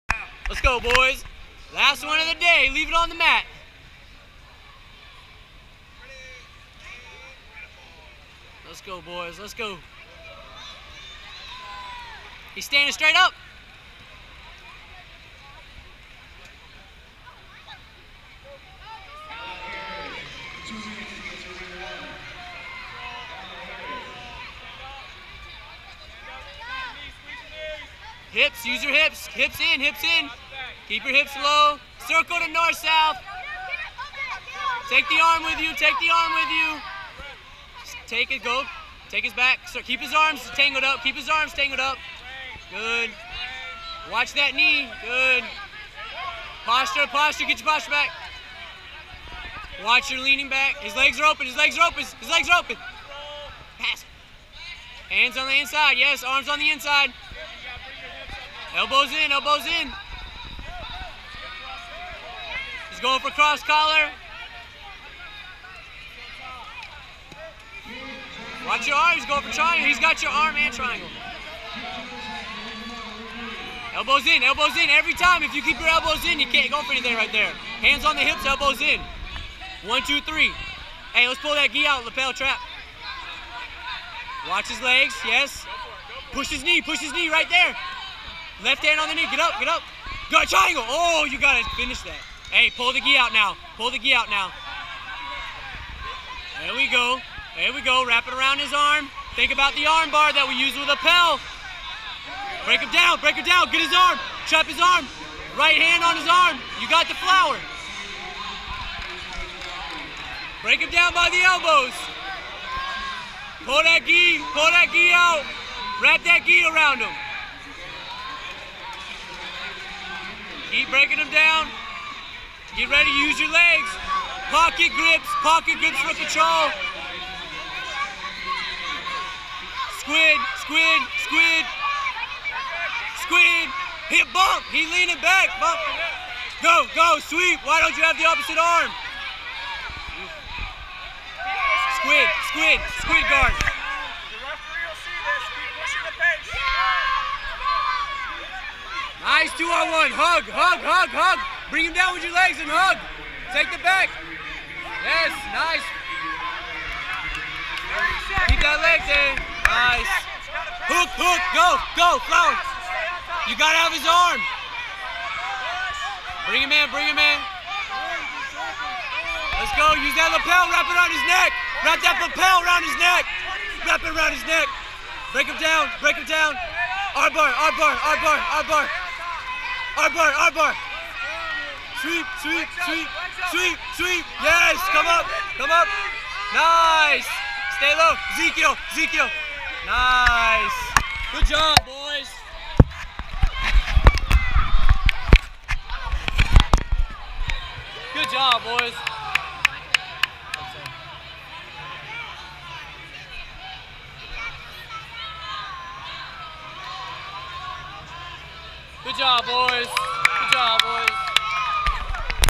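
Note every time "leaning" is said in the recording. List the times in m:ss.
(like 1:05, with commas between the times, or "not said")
0:50, 2:14.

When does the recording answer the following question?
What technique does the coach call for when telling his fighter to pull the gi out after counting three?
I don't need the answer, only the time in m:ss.
1:22.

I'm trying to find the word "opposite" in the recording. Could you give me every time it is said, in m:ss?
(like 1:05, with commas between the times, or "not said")
2:18.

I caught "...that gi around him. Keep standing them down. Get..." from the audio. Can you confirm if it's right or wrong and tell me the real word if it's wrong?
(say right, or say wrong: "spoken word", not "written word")
wrong: "breaking", not "standing".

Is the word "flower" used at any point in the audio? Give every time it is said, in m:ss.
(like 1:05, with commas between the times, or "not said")
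1:47, 2:42.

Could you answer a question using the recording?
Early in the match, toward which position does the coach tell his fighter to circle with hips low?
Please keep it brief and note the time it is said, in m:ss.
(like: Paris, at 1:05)
north-south, at 0:32.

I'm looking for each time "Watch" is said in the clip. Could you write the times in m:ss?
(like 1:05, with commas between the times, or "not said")
0:44, 0:49, 1:08, 1:24.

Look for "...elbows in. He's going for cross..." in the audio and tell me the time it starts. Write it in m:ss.
0:59.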